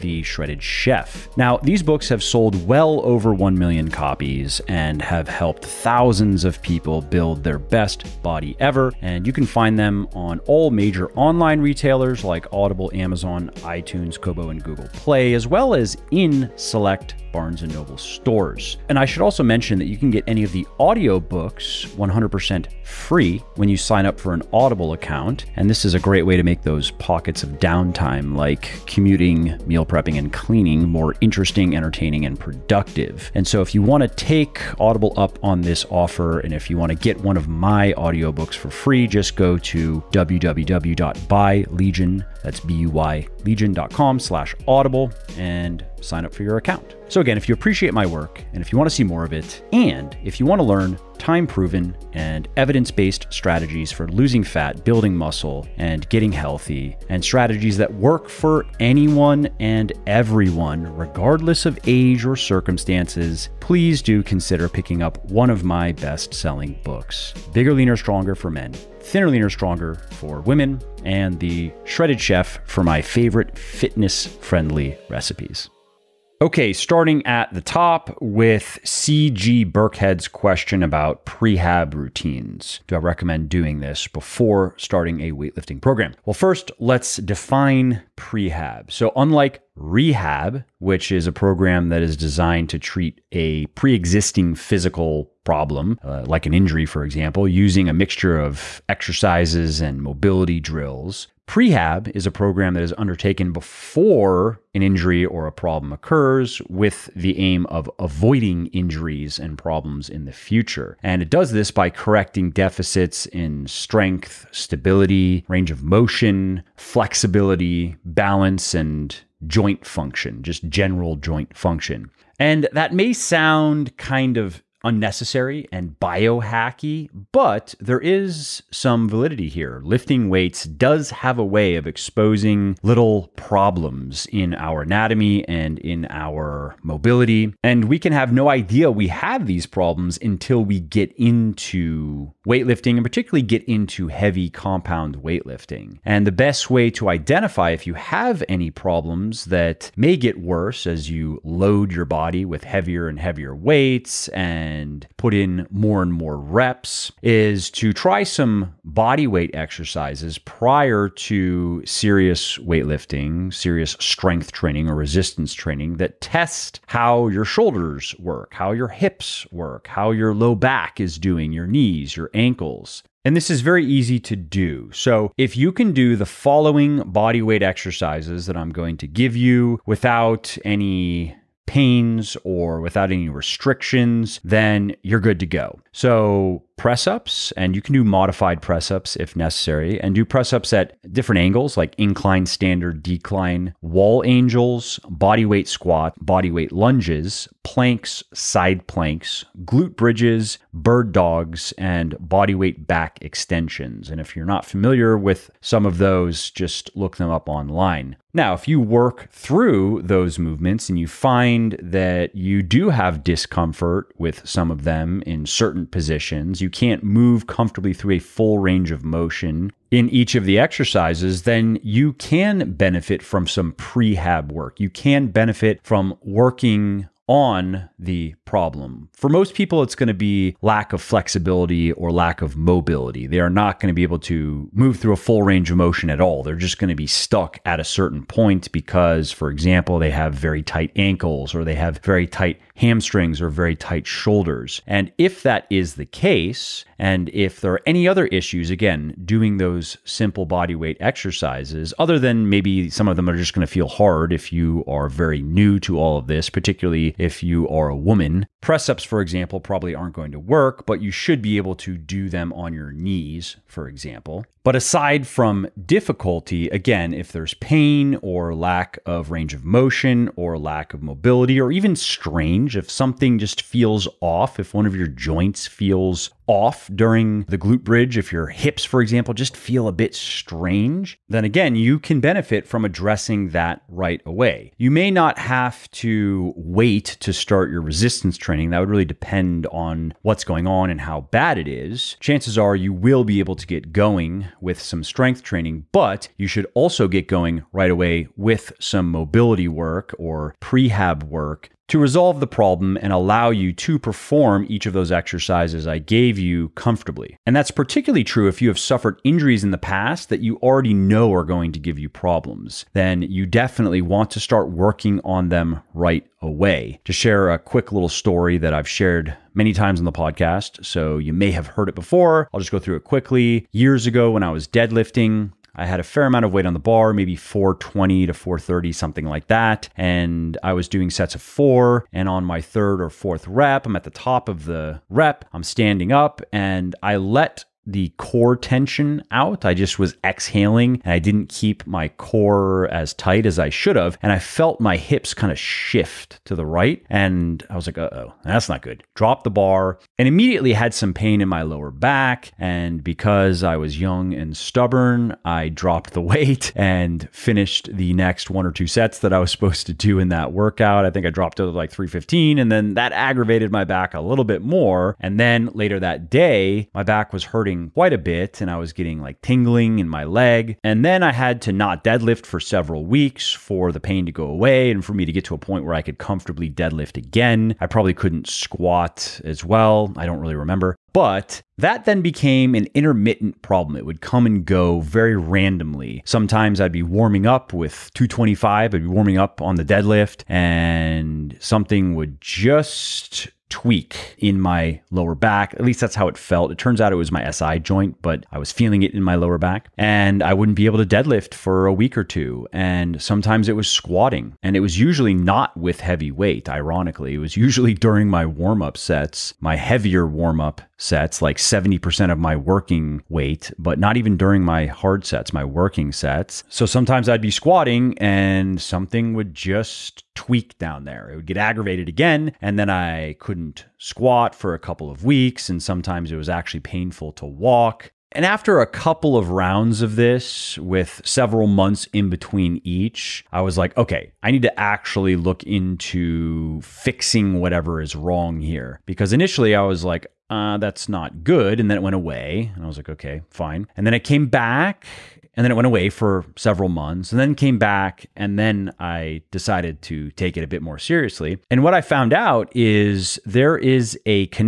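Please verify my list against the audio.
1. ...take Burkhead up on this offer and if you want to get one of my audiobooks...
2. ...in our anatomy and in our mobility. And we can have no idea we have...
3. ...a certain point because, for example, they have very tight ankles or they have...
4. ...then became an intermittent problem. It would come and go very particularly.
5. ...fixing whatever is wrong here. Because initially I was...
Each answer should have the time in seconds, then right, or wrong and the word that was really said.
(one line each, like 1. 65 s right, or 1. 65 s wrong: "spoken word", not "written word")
1. 34 s wrong: "Audible", not "Burkhead"
2. 134 s right
3. 237 s right
4. 382 s wrong: "randomly", not "particularly"
5. 436 s right.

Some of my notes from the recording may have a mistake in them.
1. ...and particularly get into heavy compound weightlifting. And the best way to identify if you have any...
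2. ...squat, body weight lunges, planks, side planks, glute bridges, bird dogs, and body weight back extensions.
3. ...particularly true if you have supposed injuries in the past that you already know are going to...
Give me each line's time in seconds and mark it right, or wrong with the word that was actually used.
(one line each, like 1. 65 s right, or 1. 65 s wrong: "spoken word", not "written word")
1. 142 s right
2. 195 s right
3. 307 s wrong: "suffered", not "supposed".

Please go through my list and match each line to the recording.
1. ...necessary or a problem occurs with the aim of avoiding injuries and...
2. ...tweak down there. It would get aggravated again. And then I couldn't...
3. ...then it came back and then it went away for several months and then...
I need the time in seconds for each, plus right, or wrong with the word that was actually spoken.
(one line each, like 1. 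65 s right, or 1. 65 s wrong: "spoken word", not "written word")
1. 104 s wrong: "injury", not "necessary"
2. 420 s right
3. 444 s right.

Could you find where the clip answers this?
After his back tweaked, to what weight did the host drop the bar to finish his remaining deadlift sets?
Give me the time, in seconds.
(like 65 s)
361 s.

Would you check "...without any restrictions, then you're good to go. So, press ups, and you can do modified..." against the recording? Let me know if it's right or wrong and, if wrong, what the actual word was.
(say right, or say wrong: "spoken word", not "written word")
right.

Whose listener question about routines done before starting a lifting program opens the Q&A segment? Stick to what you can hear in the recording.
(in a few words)
CG Burkhead.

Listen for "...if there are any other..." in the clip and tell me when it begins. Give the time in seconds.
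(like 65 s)
247 s.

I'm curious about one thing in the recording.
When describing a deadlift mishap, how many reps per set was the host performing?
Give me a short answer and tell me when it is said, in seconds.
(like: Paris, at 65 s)
4, at 331 s.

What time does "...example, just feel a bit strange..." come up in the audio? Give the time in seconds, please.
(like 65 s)
279 s.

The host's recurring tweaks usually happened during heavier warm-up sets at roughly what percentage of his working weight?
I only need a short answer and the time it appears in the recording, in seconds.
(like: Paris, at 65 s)
70%, at 411 s.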